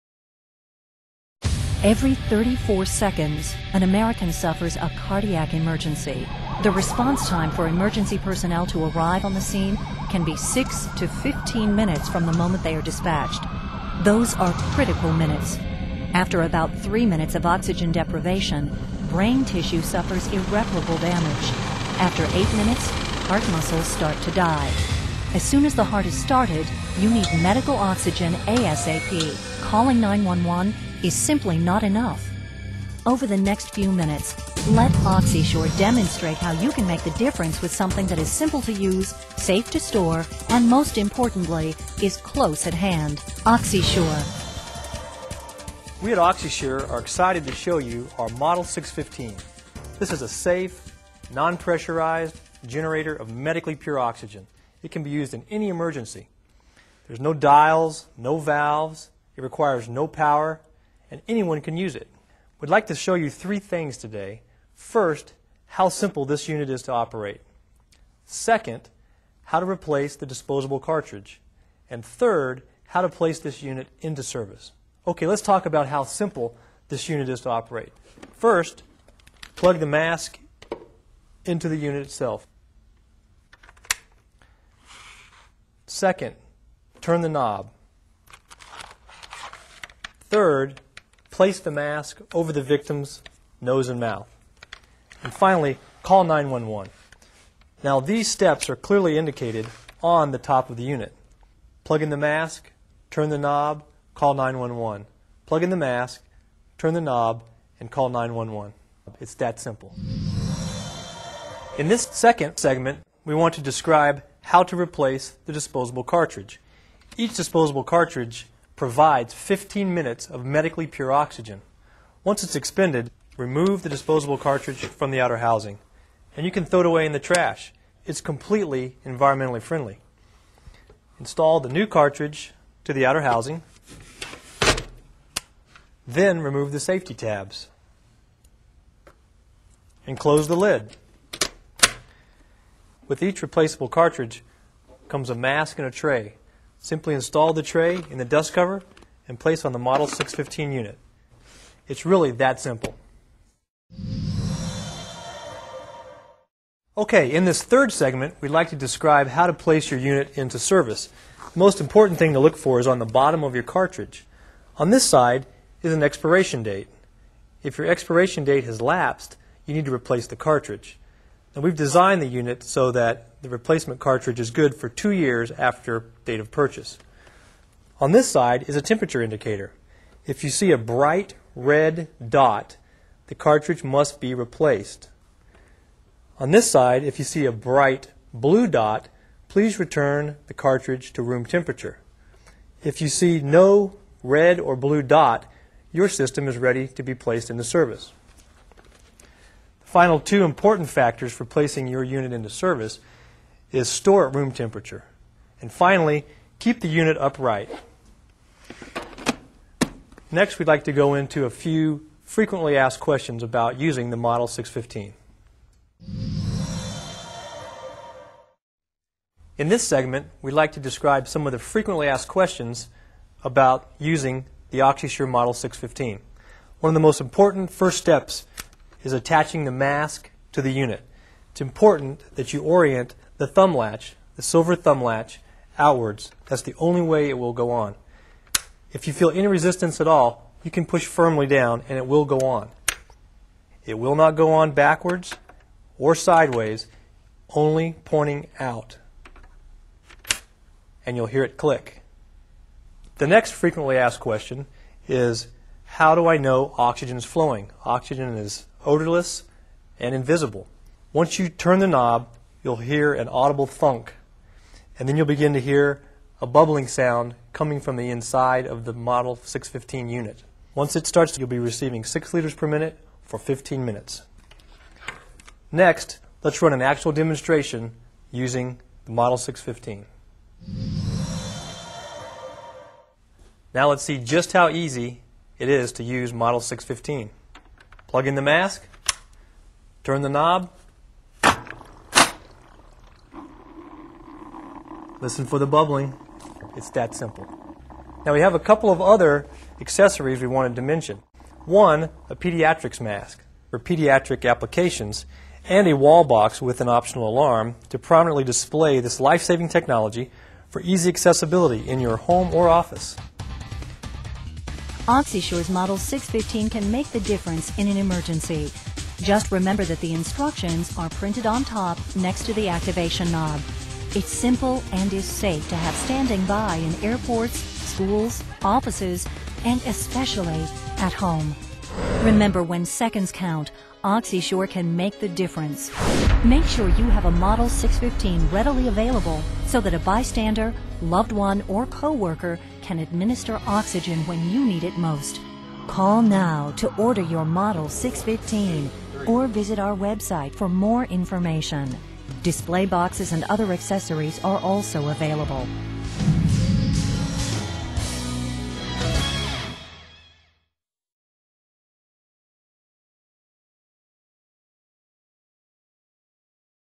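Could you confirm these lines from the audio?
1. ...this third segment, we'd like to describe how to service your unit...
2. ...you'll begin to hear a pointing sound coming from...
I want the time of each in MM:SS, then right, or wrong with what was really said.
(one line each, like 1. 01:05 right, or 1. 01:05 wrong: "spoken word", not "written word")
1. 02:37 wrong: "place", not "service"
2. 04:25 wrong: "bubbling", not "pointing".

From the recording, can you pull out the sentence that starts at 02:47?
If your expiration date has lapsed, you need to replace the cartridge.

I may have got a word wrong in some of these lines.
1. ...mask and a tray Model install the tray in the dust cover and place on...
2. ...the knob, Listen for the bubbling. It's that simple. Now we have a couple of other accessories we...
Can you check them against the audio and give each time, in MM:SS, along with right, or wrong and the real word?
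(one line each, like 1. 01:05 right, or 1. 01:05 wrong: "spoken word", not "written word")
1. 02:25 wrong: "Simply", not "Model"
2. 04:50 right.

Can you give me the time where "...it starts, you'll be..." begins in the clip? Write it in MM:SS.
04:30.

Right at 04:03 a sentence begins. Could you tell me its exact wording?
It will not go on backwards or sideways, only pointing out.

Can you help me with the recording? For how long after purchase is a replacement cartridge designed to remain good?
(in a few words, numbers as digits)
2 years.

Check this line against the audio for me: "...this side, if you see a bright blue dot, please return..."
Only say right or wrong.
right.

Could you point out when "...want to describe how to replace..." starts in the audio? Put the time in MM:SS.
01:53.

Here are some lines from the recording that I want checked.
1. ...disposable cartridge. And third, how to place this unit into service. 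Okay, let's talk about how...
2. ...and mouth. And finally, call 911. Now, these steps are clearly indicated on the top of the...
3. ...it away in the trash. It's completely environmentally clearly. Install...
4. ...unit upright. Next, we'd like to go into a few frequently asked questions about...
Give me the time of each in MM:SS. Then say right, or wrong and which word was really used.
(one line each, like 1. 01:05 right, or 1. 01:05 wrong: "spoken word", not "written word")
1. 01:10 right
2. 01:33 right
3. 02:06 wrong: "friendly", not "clearly"
4. 03:26 right.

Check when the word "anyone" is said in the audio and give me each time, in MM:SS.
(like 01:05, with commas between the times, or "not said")
01:01.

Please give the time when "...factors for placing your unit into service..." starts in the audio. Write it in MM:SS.
03:20.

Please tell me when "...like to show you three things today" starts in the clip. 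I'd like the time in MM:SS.
01:02.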